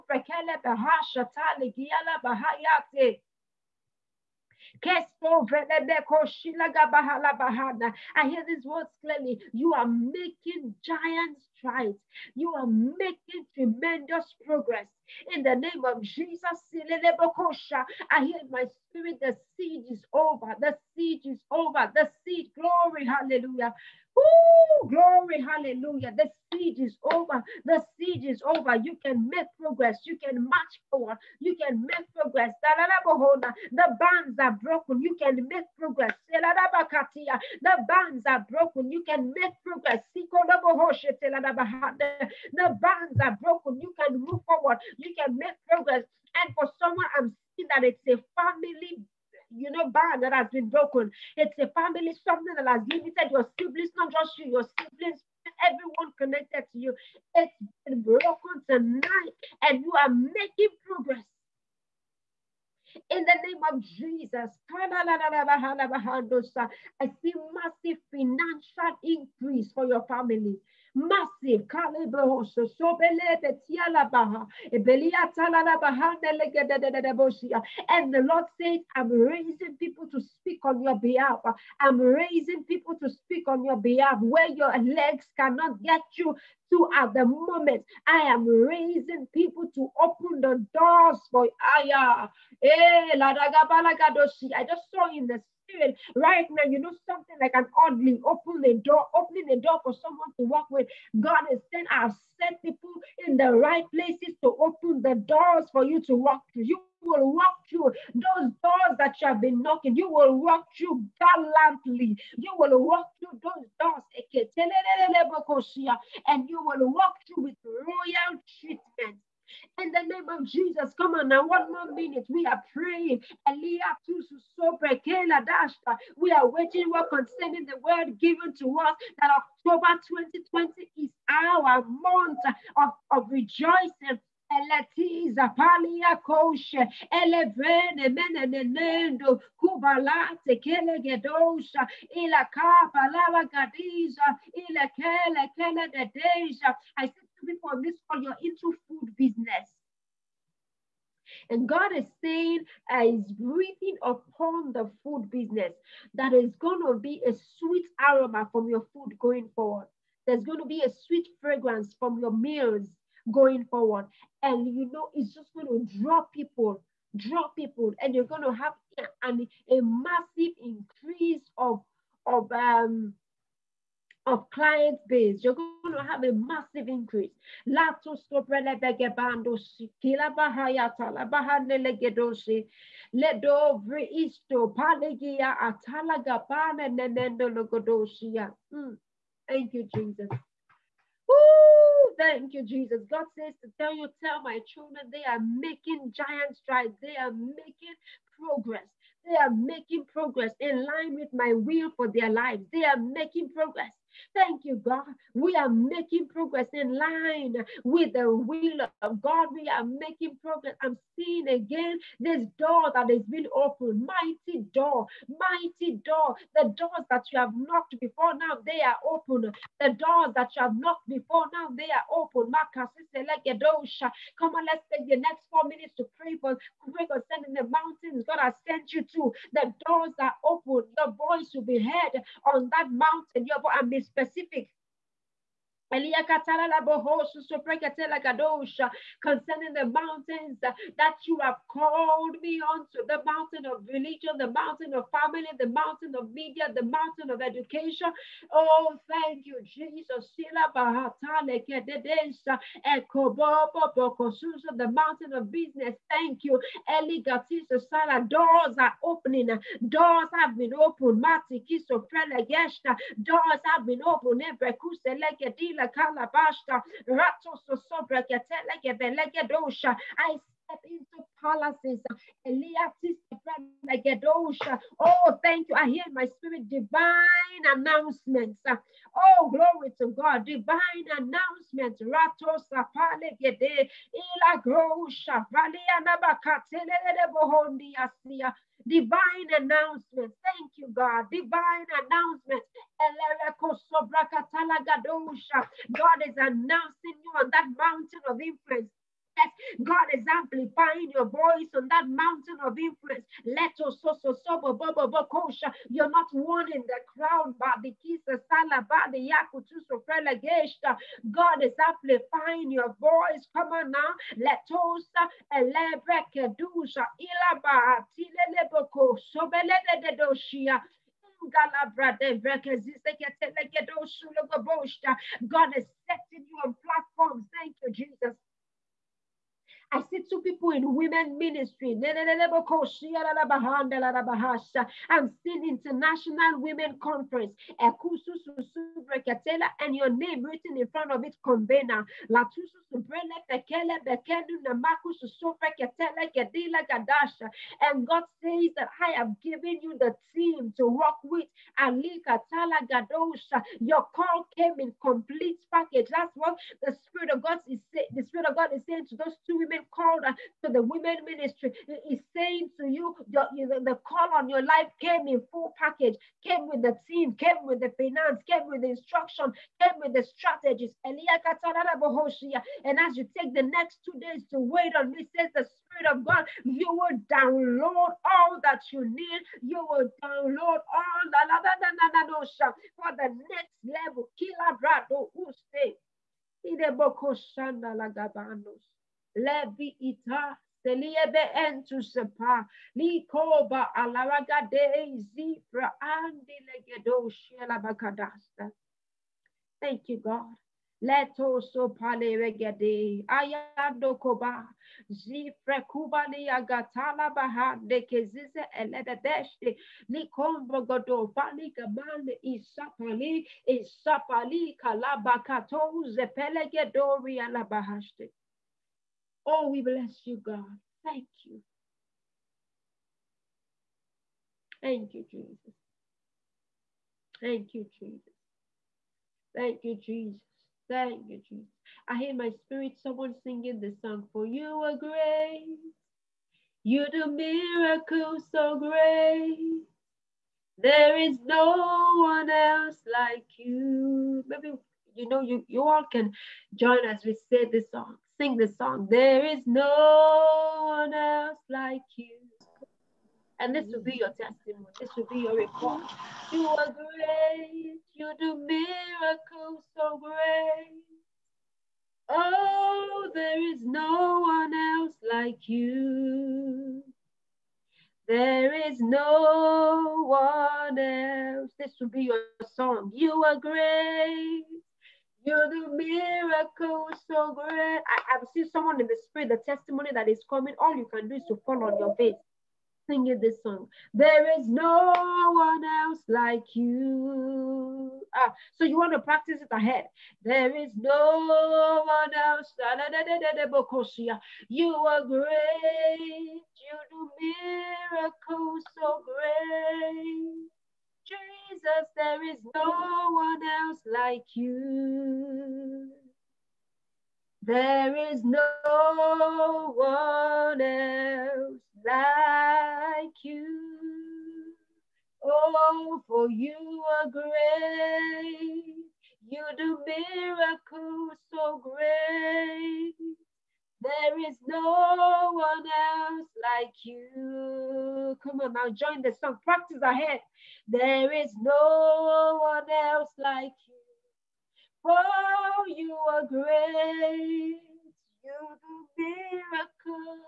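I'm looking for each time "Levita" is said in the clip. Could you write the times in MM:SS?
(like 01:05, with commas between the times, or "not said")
06:29.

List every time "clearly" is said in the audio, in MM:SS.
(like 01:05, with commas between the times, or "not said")
00:09.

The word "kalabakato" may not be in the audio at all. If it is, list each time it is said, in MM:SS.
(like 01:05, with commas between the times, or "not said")
06:54.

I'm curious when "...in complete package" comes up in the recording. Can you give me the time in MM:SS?
05:54.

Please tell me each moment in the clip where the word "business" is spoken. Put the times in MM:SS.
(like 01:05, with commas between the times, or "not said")
02:29, 02:35, 04:15.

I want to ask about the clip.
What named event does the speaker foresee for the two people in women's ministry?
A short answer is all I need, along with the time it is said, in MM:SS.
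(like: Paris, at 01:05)
International Women Conference, at 05:35.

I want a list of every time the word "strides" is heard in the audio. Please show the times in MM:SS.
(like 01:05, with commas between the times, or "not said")
00:11, 03:16.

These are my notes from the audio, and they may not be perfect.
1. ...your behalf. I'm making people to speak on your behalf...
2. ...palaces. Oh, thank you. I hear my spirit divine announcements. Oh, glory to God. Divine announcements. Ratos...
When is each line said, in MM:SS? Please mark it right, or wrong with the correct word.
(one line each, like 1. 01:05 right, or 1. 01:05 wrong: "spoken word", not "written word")
1. 01:20 wrong: "raising", not "making"
2. 04:31 right.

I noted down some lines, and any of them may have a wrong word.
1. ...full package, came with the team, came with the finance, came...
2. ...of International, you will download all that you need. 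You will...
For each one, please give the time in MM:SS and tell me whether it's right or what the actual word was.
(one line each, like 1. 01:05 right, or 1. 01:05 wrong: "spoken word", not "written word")
1. 06:05 right
2. 06:16 wrong: "God", not "International".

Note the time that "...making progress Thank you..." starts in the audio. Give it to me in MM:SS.
03:22.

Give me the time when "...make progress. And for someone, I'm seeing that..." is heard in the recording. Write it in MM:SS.
00:45.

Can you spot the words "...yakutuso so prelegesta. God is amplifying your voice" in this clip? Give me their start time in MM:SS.
05:09.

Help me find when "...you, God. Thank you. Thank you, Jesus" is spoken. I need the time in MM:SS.
07:00.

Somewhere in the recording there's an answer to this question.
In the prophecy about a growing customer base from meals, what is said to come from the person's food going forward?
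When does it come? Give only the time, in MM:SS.
02:37.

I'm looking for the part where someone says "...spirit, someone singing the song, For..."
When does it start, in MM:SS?
07:12.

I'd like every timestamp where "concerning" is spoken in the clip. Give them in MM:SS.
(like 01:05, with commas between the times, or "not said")
02:07, 03:47, 03:55.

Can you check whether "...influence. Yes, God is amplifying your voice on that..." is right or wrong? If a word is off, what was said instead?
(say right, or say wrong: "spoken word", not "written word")
right.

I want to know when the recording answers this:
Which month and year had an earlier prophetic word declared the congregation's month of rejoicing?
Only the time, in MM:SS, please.
02:09.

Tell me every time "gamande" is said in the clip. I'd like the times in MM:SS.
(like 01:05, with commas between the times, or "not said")
06:51.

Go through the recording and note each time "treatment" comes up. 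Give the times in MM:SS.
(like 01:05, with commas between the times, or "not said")
01:58.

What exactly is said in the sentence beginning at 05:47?
And God says that I have given you the team to work with.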